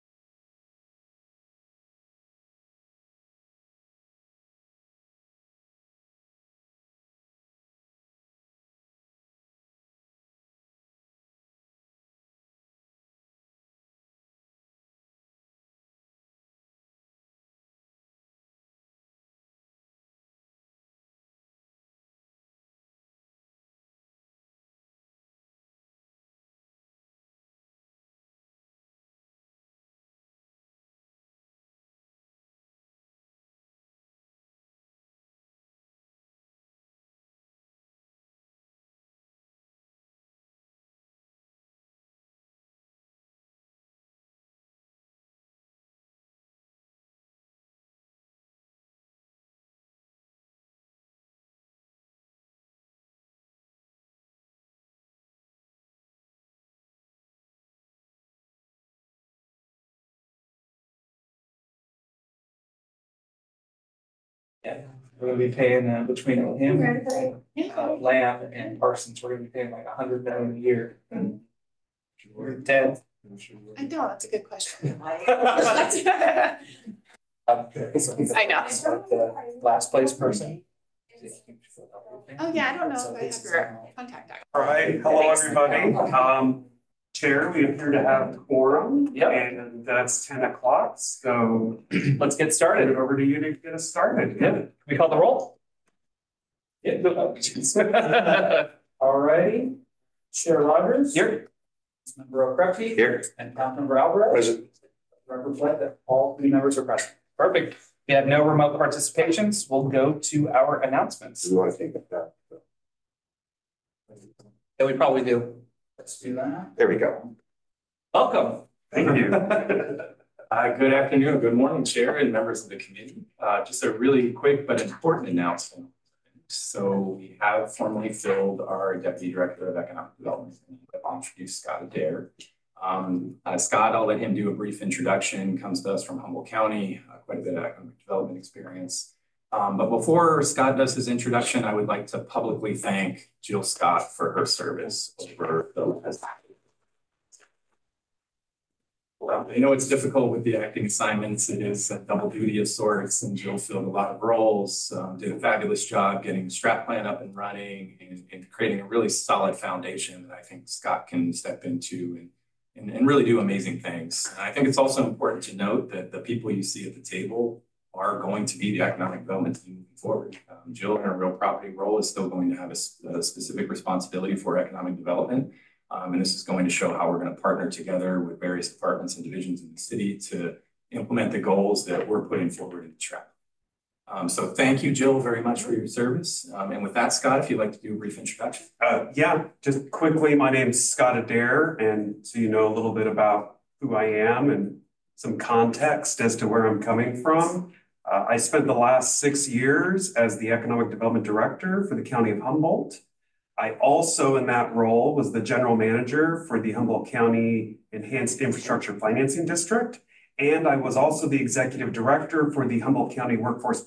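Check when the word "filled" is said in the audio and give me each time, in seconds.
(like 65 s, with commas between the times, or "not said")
128 s, 153 s.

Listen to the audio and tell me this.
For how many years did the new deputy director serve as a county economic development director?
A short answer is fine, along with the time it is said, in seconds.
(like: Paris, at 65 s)
6, at 199 s.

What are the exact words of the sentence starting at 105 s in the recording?
Record flag that all three members are present.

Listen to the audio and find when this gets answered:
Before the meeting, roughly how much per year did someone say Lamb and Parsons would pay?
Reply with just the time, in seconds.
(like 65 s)
69 s.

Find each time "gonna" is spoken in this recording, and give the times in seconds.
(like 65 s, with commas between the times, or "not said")
65 s, 69 s.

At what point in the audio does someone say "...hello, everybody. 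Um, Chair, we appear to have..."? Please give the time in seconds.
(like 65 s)
85 s.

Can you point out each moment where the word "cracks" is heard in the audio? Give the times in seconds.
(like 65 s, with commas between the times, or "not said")
not said.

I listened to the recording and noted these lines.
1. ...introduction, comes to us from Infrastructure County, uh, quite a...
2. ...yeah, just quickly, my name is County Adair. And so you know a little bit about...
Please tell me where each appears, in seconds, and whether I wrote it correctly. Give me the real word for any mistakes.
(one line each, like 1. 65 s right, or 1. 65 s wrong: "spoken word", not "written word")
1. 134 s wrong: "Humboldt", not "Infrastructure"
2. 189 s wrong: "Scott", not "County".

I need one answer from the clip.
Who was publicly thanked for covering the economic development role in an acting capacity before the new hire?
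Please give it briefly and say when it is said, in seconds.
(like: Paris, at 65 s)
Jill Scott, at 143 s.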